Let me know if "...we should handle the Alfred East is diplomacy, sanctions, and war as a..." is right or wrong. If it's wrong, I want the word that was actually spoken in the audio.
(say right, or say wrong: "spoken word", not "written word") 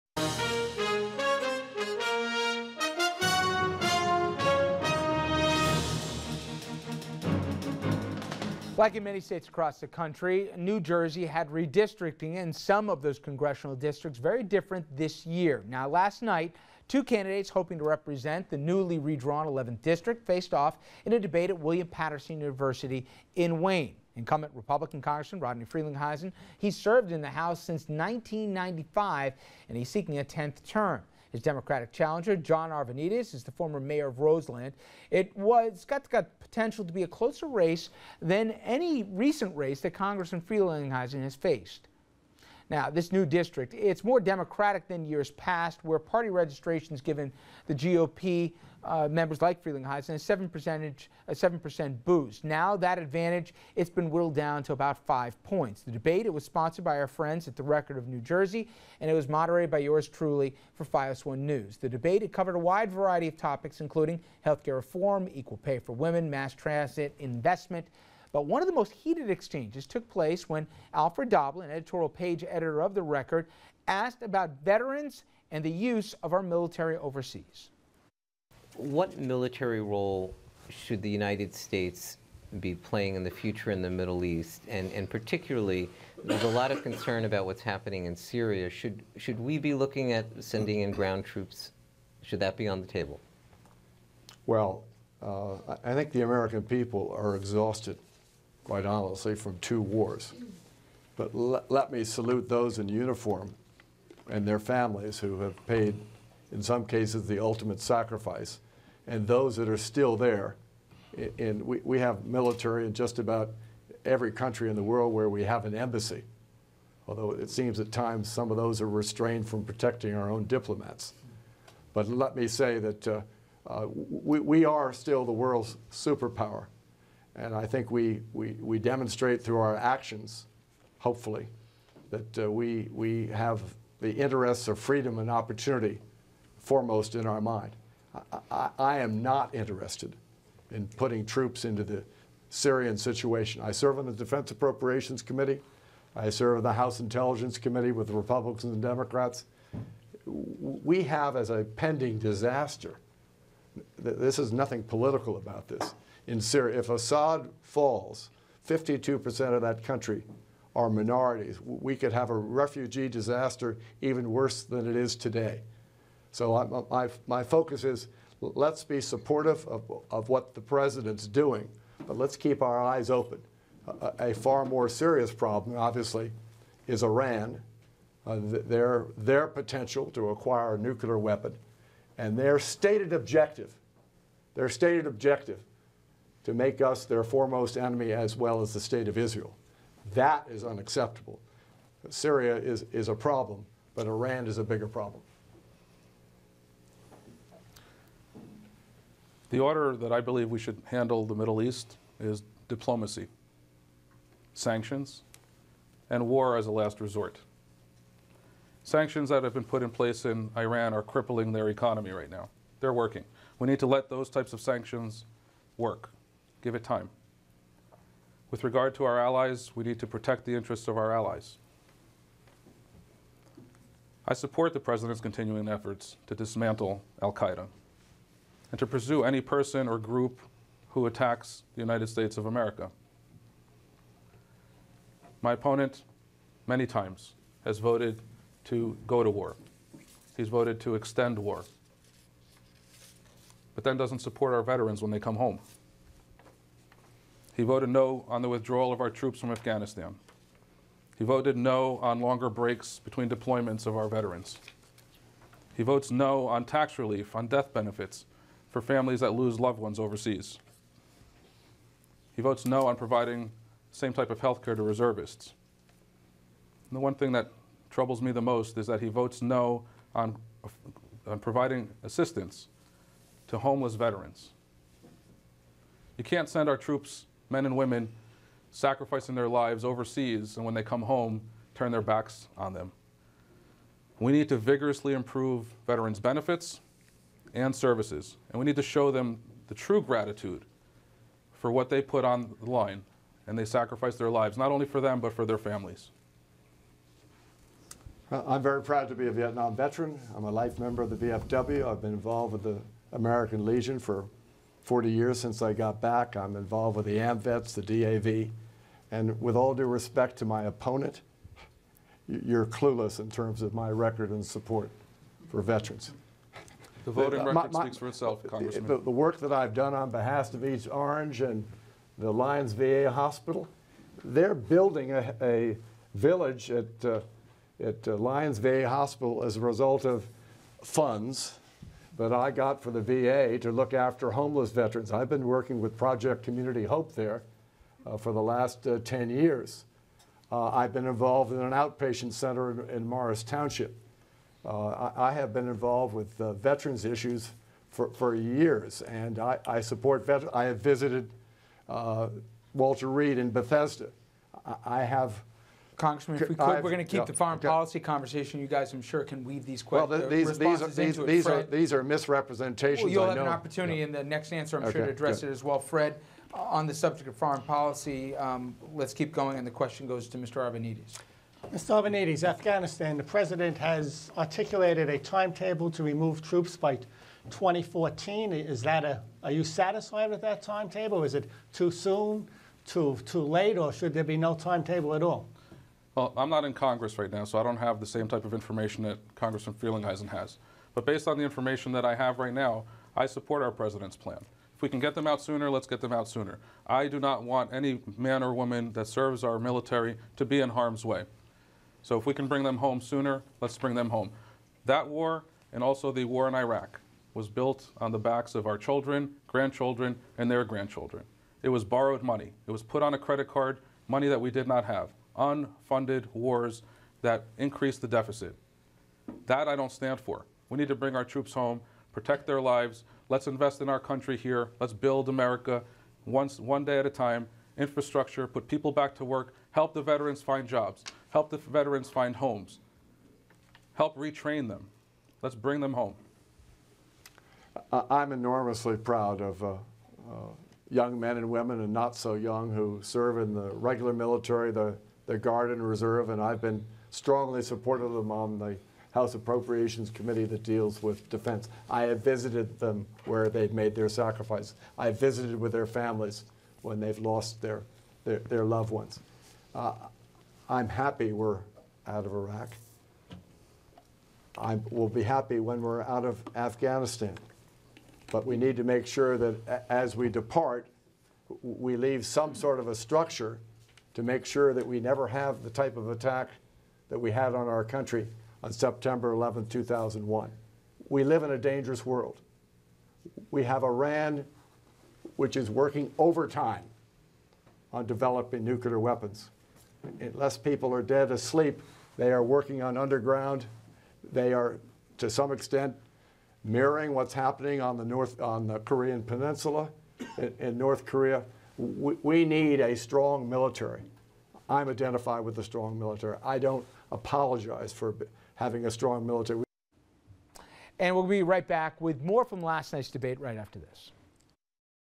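wrong: "Middle", not "Alfred".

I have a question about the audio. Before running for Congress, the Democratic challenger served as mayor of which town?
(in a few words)
Roseland.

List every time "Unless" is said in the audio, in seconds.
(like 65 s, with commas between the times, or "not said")
490 s.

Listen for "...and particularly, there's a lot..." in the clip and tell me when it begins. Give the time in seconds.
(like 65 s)
84 s.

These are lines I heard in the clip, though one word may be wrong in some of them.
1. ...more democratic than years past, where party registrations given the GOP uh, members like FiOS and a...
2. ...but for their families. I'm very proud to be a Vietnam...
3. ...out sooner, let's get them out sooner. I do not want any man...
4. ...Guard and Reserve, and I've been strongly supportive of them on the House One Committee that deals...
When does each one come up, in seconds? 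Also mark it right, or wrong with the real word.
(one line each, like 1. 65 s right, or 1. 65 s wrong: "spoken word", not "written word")
1. 44 s wrong: "Freeling", not "FiOS"
2. 295 s right
3. 395 s right
4. 445 s wrong: "Appropriations", not "One".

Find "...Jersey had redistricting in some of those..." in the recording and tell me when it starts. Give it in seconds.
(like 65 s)
10 s.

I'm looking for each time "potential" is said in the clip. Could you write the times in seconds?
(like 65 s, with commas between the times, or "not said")
36 s, 179 s.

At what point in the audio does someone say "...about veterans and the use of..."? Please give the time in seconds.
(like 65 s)
74 s.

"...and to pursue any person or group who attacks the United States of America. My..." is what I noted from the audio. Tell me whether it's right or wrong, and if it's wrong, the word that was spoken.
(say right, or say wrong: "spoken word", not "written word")
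right.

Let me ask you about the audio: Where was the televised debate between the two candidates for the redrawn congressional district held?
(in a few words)
William Paterson University.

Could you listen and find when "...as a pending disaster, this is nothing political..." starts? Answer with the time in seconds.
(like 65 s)
151 s.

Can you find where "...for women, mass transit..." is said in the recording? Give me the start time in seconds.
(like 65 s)
65 s.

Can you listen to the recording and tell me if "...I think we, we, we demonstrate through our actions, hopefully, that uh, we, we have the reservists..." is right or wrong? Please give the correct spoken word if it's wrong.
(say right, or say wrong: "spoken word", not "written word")
wrong: "interests", not "reservists".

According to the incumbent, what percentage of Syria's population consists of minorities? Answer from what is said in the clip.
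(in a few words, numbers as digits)
52%.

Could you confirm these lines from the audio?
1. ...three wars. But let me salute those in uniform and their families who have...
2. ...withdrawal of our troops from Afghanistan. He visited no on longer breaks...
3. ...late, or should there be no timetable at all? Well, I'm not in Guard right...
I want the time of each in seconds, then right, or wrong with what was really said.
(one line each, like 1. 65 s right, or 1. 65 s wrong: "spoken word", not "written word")
1. 99 s wrong: "two", not "three"
2. 248 s wrong: "voted", not "visited"
3. 383 s wrong: "Congress", not "Guard".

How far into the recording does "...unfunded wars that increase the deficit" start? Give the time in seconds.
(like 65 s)
415 s.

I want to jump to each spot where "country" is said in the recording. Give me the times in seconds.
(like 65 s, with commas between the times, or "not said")
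9 s, 114 s, 159 s, 423 s, 477 s.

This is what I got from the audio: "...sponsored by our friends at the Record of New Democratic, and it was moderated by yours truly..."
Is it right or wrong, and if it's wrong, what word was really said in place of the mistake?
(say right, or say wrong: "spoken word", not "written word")
wrong: "Jersey", not "Democratic".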